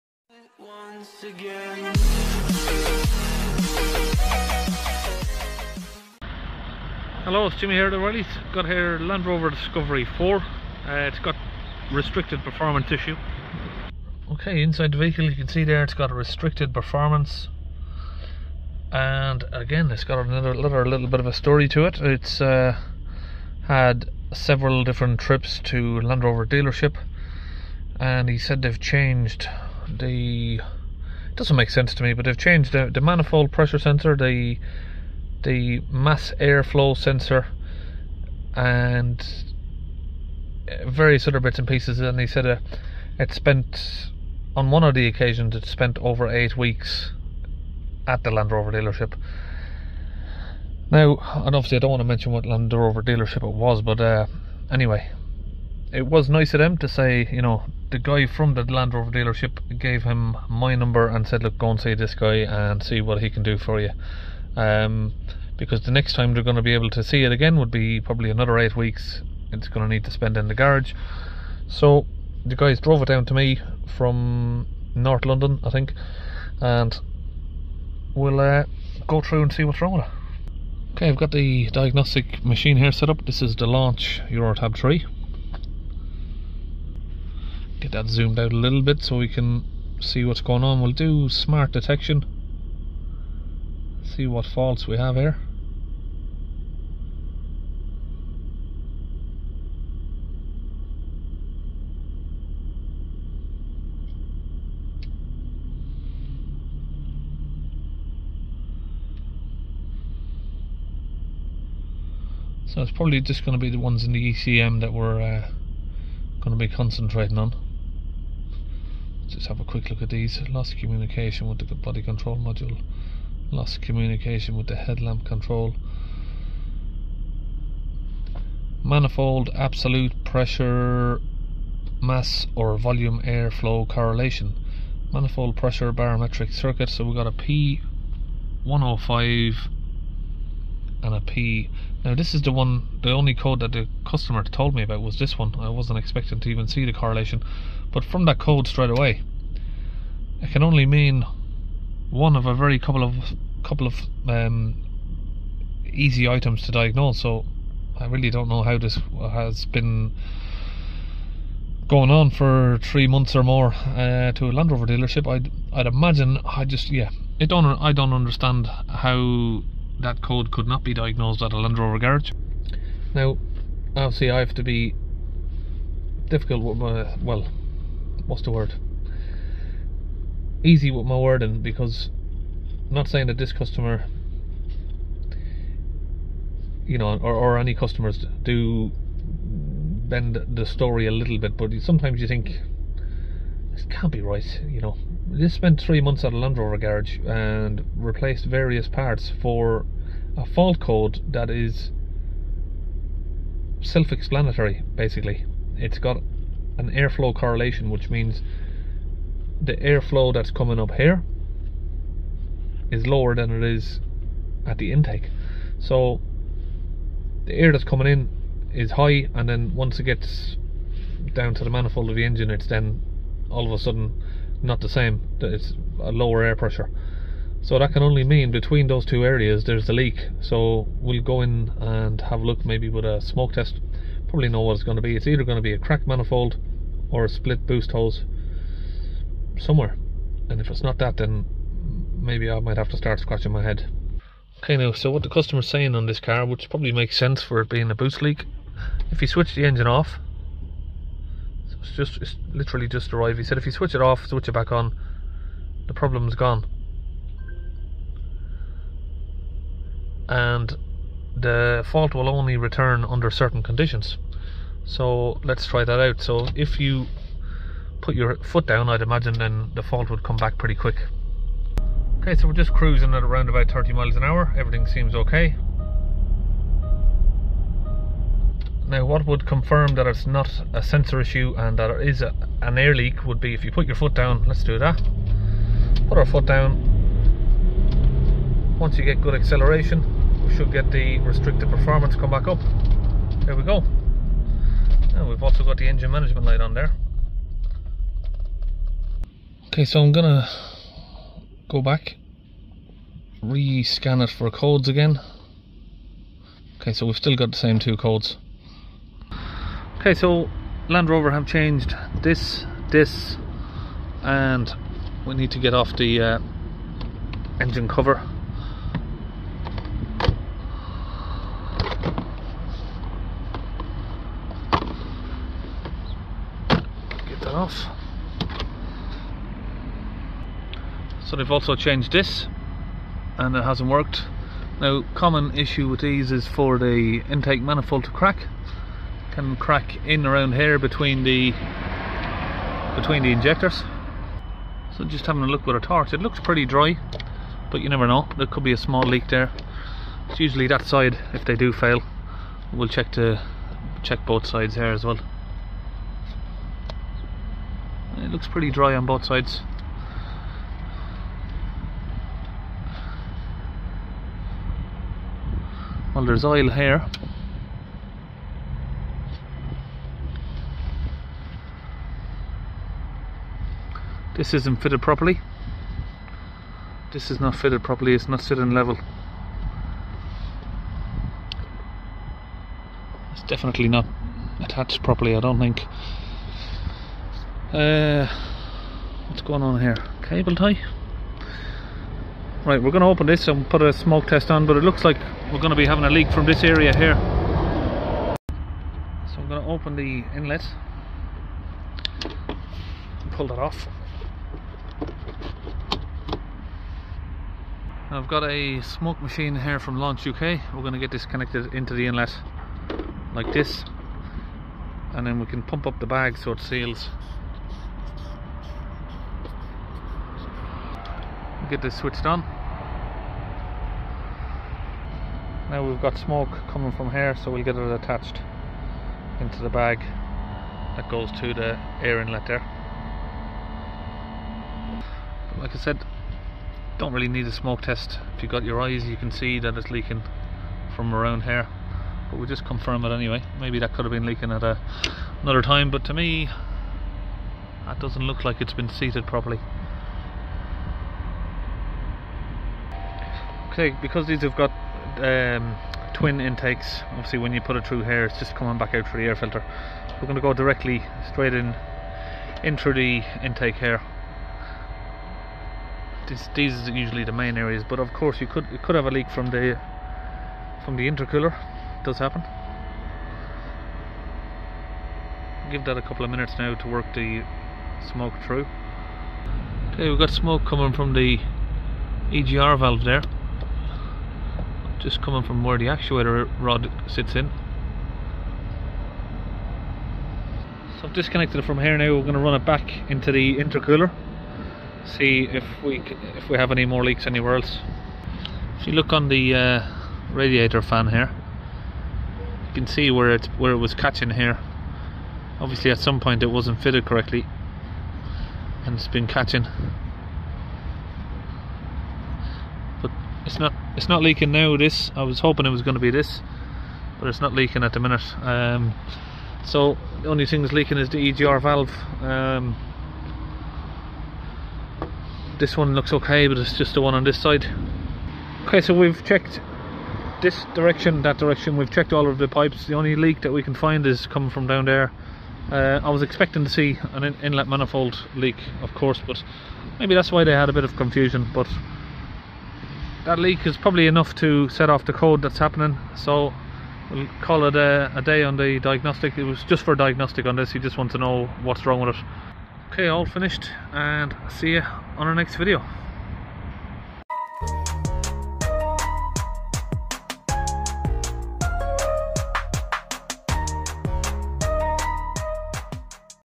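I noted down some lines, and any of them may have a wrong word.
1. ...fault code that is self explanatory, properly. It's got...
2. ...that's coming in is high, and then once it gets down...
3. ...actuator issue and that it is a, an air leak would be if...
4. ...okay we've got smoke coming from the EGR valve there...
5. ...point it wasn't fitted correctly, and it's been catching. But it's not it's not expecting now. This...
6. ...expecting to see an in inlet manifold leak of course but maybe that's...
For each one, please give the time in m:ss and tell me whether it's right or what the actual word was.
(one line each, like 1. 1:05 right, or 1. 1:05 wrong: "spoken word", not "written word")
1. 3:20 wrong: "basically", not "properly"
2. 3:37 right
3. 4:40 wrong: "sensor", not "actuator"
4. 7:59 right
5. 8:26 wrong: "leaking", not "expecting"
6. 8:56 right.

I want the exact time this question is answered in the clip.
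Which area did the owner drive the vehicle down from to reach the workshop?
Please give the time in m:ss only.
1:14.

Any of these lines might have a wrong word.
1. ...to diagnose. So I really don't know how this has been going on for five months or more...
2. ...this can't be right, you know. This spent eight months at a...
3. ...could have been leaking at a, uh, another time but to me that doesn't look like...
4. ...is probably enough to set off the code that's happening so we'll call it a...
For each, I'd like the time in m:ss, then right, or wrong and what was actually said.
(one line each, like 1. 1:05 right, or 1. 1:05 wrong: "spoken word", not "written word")
1. 2:36 wrong: "three", not "five"
2. 3:13 wrong: "three", not "eight"
3. 7:23 right
4. 9:03 right.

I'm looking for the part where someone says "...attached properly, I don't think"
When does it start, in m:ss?
6:24.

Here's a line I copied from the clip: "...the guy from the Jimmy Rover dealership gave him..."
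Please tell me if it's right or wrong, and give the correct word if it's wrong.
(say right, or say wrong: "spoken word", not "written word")
wrong: "Land", not "Jimmy".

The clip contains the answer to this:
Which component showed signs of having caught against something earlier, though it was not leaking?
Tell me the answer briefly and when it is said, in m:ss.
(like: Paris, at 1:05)
radiator fan, at 8:20.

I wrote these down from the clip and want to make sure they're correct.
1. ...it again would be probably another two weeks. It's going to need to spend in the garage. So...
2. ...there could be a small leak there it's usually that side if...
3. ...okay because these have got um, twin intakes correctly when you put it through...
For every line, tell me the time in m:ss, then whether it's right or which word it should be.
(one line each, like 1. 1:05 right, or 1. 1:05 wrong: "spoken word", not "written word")
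1. 1:07 wrong: "eight", not "two"
2. 5:48 right
3. 7:33 wrong: "obviously", not "correctly".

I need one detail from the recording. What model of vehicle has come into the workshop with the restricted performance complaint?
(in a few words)
Land Rover Discovery 4.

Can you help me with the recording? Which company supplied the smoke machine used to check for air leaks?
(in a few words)
Launch UK.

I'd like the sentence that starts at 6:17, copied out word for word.
This is not fitted properly, it's not sitting level.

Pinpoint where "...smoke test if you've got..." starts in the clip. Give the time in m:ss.
7:17.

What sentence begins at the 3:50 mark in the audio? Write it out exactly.
So we'll go in and have a look maybe with a smoke test.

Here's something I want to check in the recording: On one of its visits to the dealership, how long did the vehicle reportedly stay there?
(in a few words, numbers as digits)
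over 8 weeks.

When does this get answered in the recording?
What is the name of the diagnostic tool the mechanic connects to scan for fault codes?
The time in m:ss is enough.
1:23.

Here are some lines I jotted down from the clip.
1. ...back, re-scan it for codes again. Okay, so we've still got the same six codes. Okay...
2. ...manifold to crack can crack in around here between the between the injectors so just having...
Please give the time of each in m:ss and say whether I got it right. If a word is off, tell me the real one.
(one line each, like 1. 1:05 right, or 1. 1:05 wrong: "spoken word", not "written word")
1. 5:01 wrong: "two", not "six"
2. 5:37 right.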